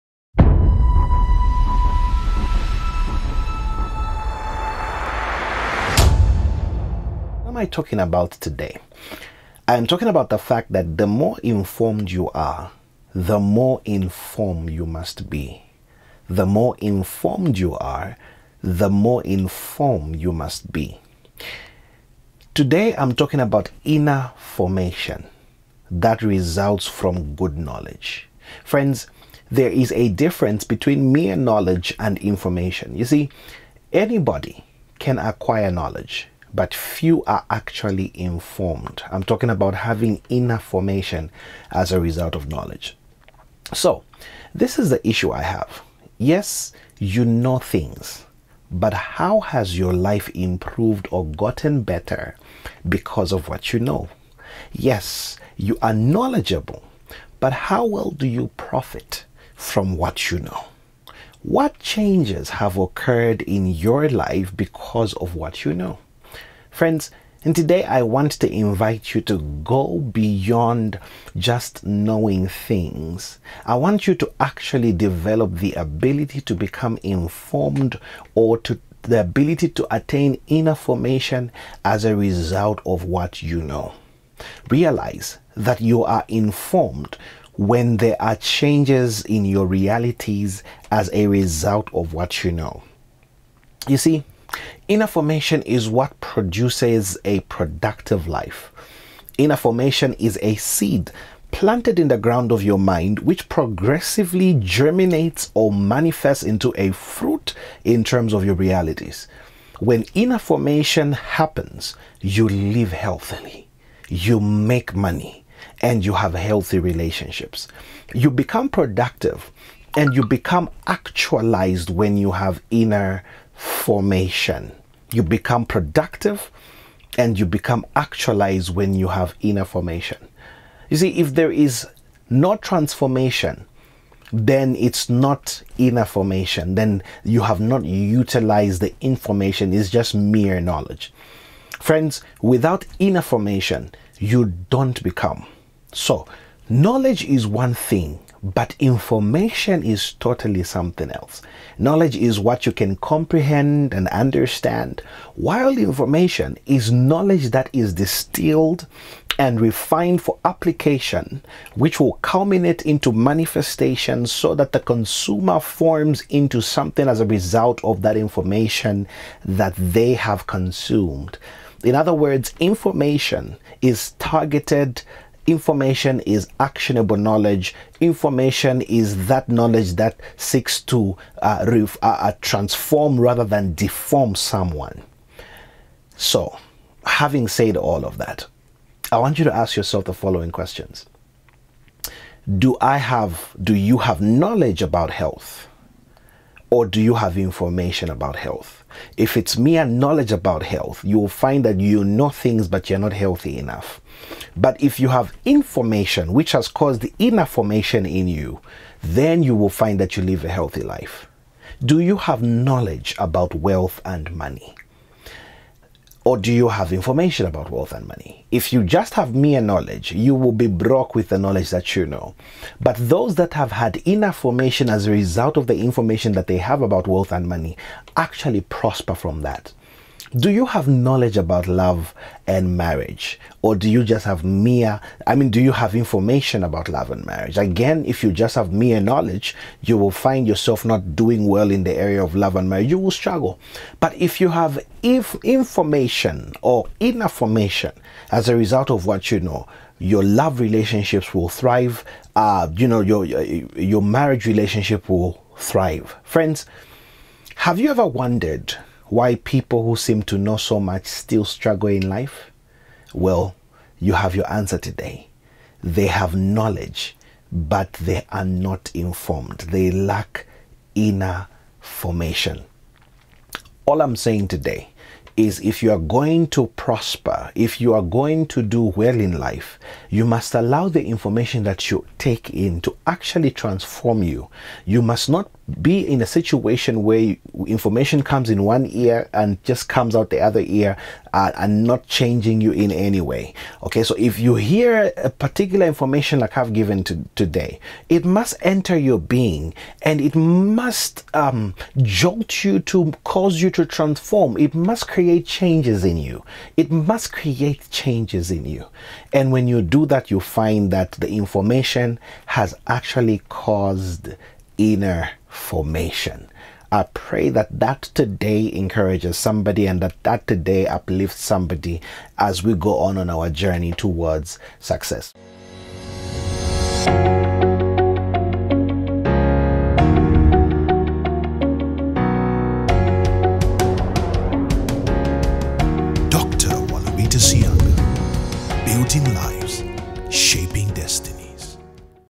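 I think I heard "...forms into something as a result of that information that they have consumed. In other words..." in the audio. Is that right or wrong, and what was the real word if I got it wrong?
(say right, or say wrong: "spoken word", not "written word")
right.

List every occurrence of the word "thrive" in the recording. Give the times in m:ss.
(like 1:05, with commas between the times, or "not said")
4:11, 4:15.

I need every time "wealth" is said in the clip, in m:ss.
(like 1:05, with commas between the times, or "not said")
3:33, 3:37, 3:47.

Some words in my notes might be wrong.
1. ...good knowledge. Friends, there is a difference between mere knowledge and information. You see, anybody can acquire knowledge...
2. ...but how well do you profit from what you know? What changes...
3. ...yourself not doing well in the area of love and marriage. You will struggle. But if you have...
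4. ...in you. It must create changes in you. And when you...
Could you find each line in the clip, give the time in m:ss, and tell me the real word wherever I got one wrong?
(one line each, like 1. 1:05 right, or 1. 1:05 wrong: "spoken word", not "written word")
1. 0:27 right
2. 0:57 right
3. 4:00 right
4. 5:06 right.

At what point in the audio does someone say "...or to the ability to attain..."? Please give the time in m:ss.
1:18.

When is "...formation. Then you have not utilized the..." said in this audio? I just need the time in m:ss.
2:16.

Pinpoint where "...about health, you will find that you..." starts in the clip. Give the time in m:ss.
3:20.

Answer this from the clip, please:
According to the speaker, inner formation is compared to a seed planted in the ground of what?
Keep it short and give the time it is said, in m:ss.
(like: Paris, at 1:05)
your mind, at 1:42.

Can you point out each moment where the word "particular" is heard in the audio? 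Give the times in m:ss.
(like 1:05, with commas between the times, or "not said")
4:55.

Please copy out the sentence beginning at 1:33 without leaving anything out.
You see, Inner formation is what produces a productive life.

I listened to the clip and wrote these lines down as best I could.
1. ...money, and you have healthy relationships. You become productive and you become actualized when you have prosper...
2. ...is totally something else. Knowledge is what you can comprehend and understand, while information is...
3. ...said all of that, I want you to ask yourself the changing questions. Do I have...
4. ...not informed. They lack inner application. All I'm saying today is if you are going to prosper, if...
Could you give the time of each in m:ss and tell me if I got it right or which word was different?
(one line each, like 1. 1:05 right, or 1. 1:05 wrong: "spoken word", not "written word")
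1. 1:54 wrong: "inner", not "prosper"
2. 2:29 right
3. 3:07 wrong: "following", not "changing"
4. 4:28 wrong: "formation", not "application".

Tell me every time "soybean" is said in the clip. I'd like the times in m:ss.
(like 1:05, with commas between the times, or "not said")
not said.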